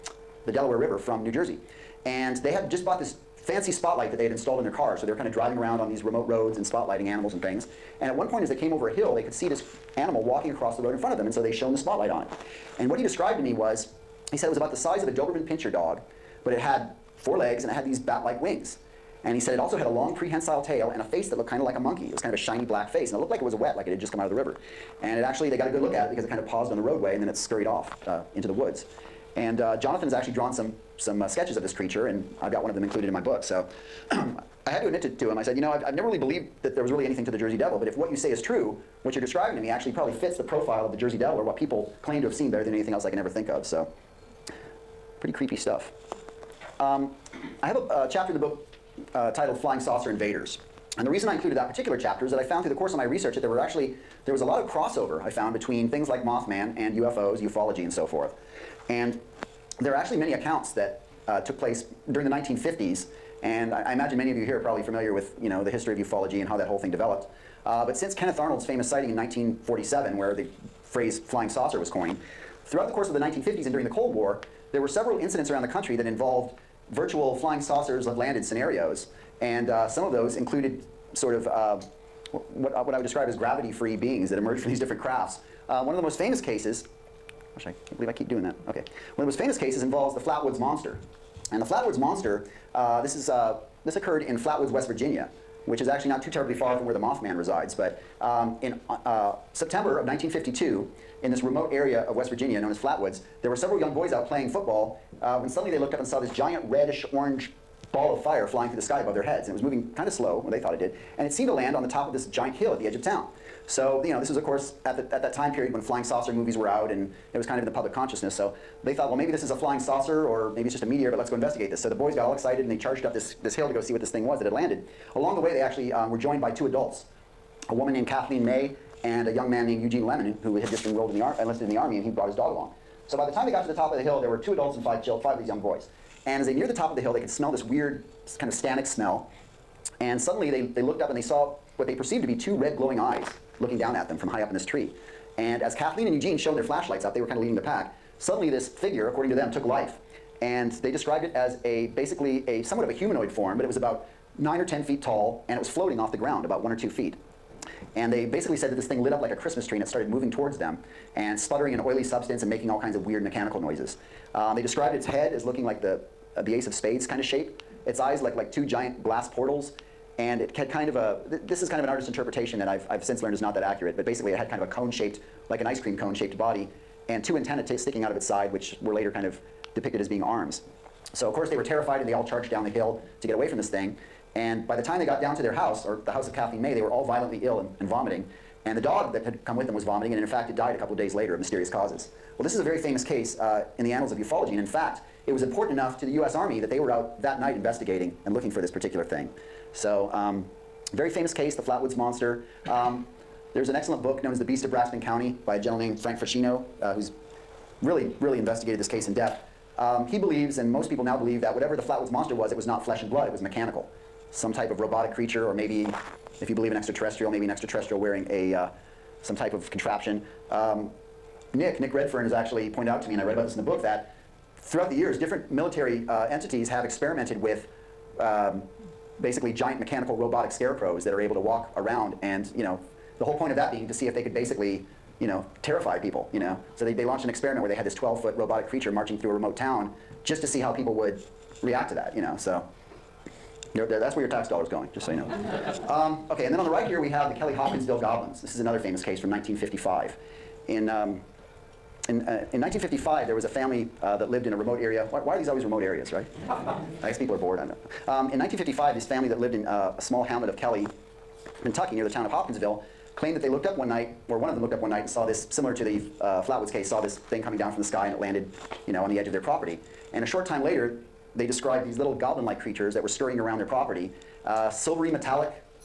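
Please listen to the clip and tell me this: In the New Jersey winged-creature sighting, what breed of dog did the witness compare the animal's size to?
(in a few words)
Doberman Pinscher.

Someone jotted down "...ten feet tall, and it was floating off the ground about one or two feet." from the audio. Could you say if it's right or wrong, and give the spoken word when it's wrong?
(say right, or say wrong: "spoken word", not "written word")
right.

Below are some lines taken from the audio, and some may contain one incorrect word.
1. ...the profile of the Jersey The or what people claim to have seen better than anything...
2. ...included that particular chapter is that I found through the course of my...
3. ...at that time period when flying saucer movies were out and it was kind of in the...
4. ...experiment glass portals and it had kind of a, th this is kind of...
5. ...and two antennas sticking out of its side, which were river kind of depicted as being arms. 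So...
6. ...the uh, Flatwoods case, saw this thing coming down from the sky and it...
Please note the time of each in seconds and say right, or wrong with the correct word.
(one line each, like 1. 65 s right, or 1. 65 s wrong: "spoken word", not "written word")
1. 40 s wrong: "Devil", not "The"
2. 51 s right
3. 115 s right
4. 168 s wrong: "giant", not "experiment"
5. 177 s wrong: "later", not "river"
6. 265 s right.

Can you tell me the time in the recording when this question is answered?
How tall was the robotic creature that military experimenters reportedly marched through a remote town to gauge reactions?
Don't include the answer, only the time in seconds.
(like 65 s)
237 s.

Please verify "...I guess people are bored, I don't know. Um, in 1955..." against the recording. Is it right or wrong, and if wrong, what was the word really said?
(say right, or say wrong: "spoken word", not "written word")
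right.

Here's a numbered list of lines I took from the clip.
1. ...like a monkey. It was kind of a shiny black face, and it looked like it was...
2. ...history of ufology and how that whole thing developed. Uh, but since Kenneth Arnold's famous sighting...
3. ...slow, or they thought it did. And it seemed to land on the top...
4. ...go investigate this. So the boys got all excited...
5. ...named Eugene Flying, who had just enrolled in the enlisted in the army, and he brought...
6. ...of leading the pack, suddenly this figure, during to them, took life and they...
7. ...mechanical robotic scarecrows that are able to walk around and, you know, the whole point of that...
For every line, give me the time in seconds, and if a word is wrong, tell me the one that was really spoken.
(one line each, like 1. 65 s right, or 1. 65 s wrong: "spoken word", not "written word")
1. 21 s right
2. 65 s right
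3. 110 s right
4. 121 s right
5. 129 s wrong: "Lemon", not "Flying"
6. 147 s wrong: "according", not "during"
7. 229 s right.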